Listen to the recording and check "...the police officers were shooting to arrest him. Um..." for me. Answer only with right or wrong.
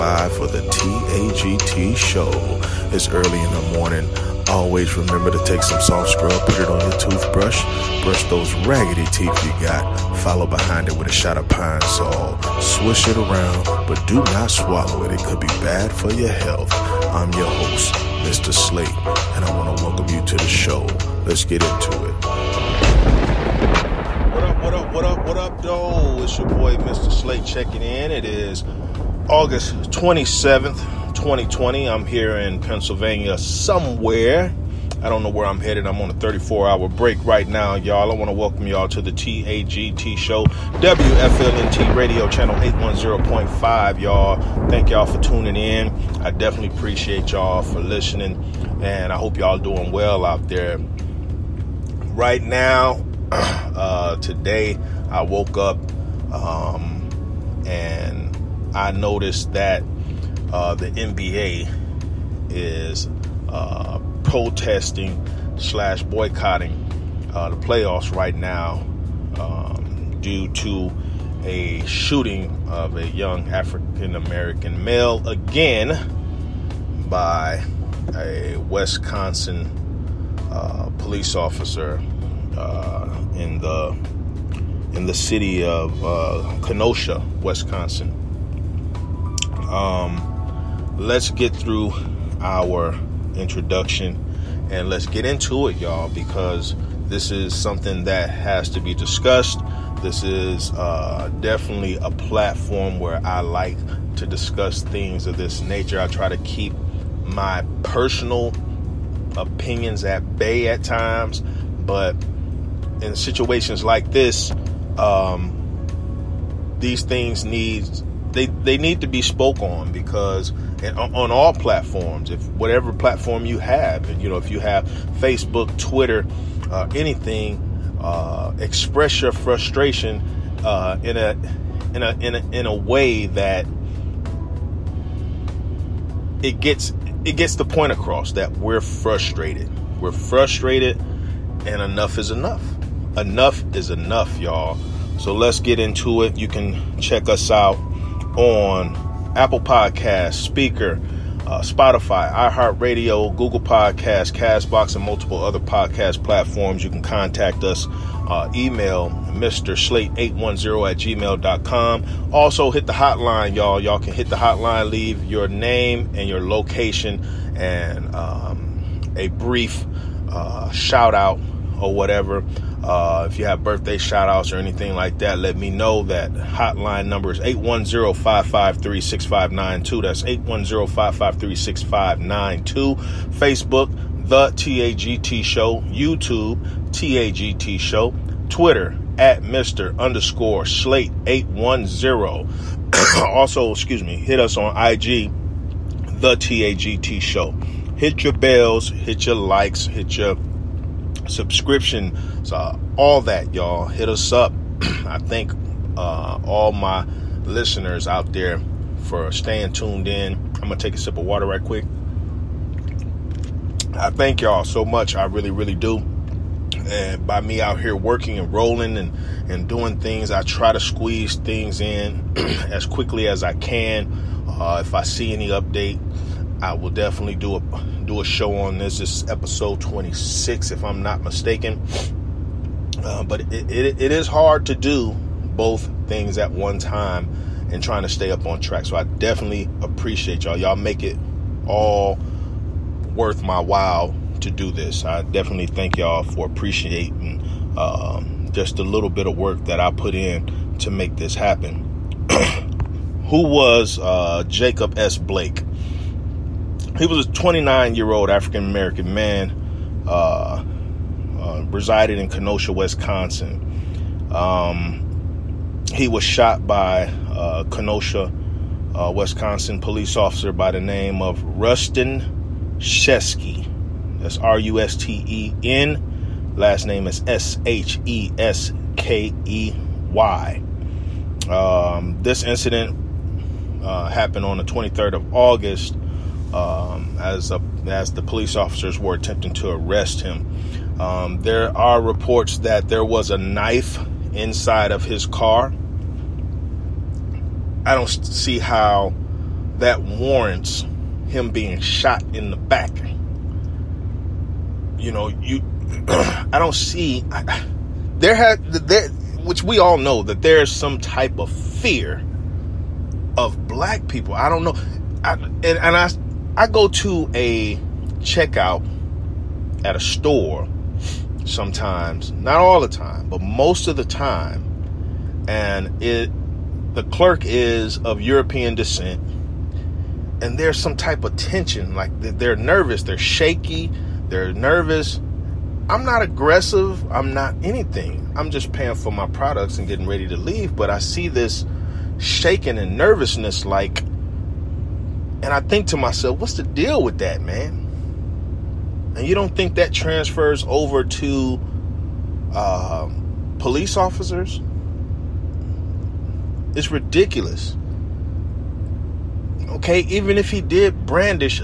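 wrong.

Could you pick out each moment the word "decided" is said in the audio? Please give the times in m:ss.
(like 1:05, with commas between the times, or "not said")
not said.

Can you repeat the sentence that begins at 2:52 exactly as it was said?
Uh, if you have birthday shout outs or anything like that, let me know.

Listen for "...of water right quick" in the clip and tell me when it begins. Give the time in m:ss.
3:31.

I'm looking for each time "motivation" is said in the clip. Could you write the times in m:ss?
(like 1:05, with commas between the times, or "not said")
not said.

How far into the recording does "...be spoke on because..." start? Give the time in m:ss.
1:59.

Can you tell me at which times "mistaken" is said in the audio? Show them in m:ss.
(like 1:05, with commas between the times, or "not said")
3:51.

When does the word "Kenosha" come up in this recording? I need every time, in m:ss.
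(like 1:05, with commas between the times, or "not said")
1:26, 4:22, 4:27.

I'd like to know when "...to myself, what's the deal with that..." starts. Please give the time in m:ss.
5:45.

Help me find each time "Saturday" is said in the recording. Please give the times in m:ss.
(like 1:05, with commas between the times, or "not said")
not said.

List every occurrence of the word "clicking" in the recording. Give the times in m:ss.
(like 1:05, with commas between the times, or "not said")
not said.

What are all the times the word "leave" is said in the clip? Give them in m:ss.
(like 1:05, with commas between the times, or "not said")
2:44, 5:40.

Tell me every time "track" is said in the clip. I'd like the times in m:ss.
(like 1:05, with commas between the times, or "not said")
3:58.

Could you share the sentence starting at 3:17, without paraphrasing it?
Hit your bells, hit your likes, hit your subscription, so all that, y'all.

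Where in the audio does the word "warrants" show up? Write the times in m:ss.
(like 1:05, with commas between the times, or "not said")
5:00.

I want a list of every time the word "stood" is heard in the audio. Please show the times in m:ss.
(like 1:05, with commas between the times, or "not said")
not said.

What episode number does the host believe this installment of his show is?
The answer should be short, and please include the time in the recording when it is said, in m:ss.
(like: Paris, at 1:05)
26, at 3:49.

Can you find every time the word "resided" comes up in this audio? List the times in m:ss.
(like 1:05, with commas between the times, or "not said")
4:21.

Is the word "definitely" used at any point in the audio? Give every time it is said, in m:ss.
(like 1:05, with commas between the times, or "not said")
0:46, 1:41, 3:46, 3:59, 4:05.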